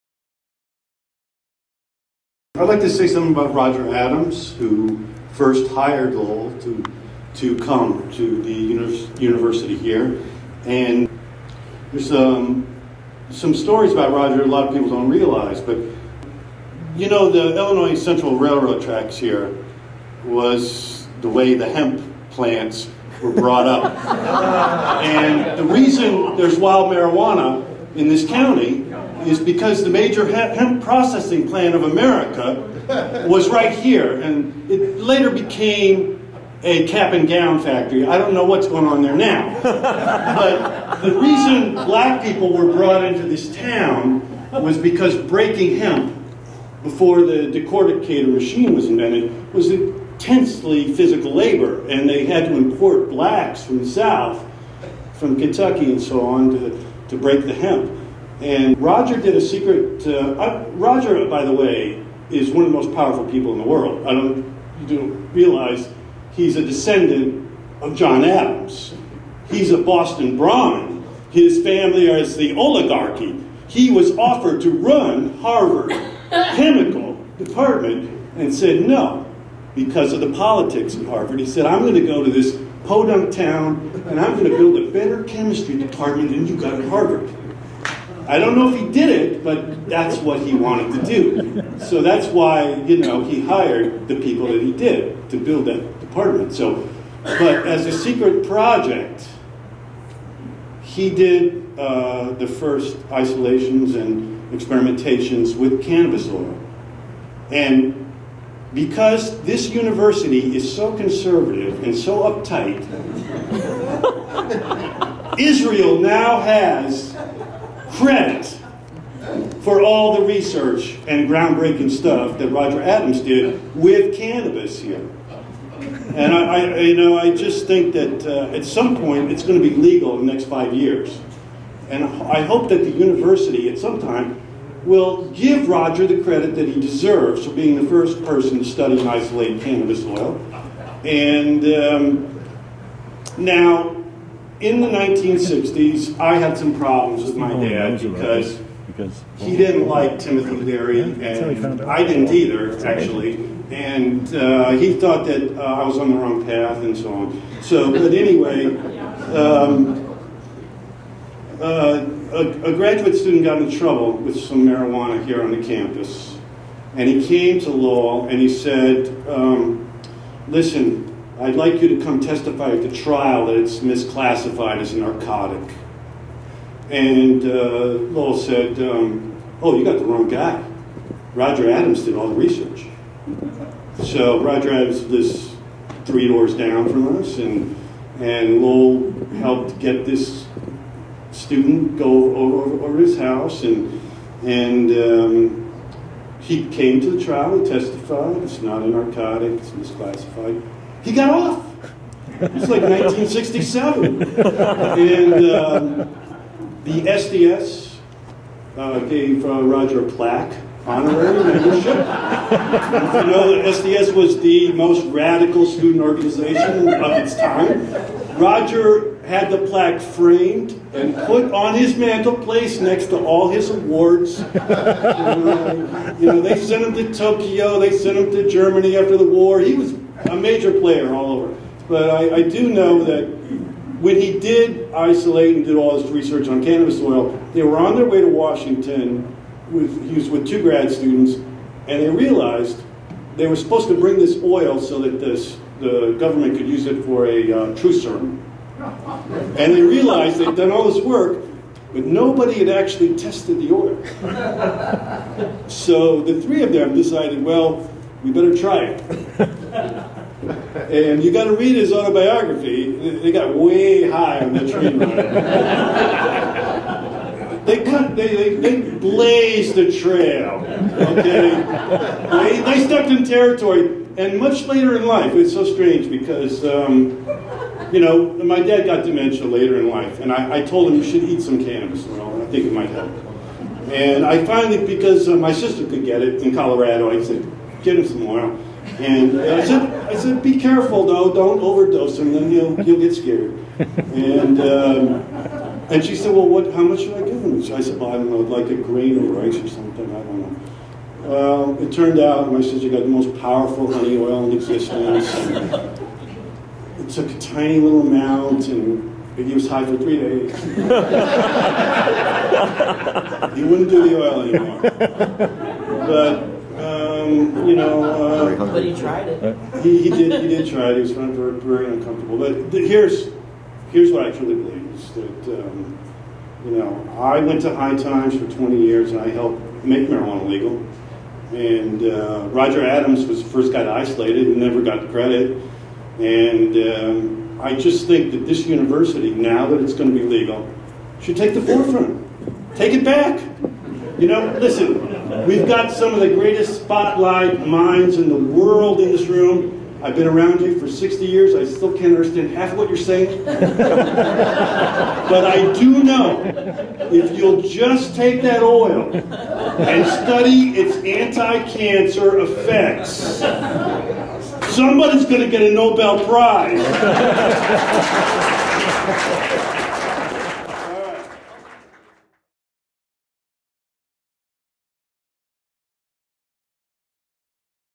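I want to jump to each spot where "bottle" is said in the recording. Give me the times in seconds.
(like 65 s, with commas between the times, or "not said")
not said.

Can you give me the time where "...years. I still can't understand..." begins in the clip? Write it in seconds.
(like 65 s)
351 s.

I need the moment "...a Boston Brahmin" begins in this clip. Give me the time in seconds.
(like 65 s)
69 s.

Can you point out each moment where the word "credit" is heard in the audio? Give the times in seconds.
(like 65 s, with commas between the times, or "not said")
118 s, 136 s, 335 s.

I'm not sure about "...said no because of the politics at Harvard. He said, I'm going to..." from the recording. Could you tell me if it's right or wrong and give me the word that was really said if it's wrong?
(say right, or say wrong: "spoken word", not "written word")
right.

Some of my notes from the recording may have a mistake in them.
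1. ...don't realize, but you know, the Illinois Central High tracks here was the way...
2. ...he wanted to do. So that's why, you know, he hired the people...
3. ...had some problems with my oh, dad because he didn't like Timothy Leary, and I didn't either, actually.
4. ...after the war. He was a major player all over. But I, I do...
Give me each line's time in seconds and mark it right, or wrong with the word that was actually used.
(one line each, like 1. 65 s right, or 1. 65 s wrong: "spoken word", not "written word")
1. 14 s wrong: "Railroad", not "High"
2. 90 s right
3. 146 s right
4. 228 s right.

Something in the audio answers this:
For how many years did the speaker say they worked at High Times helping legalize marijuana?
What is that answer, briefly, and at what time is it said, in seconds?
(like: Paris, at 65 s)
20, at 328 s.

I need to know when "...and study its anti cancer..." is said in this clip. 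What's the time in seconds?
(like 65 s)
359 s.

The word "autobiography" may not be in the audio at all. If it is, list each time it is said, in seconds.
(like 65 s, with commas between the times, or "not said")
261 s.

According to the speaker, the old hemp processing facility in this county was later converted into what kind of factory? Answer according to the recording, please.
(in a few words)
cap and gown factory.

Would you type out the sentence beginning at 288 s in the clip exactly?
And I said, I said, be careful though, don't overdose him, then he'll, he'll get scared.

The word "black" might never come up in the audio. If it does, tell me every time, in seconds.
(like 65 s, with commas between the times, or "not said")
41 s, 53 s.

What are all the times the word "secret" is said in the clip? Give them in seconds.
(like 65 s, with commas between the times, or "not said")
59 s, 97 s.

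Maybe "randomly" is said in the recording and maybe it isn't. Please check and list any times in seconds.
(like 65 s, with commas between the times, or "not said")
not said.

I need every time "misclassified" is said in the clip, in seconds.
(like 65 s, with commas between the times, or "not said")
173 s, 199 s.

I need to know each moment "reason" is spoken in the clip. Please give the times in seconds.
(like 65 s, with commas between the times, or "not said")
25 s, 41 s.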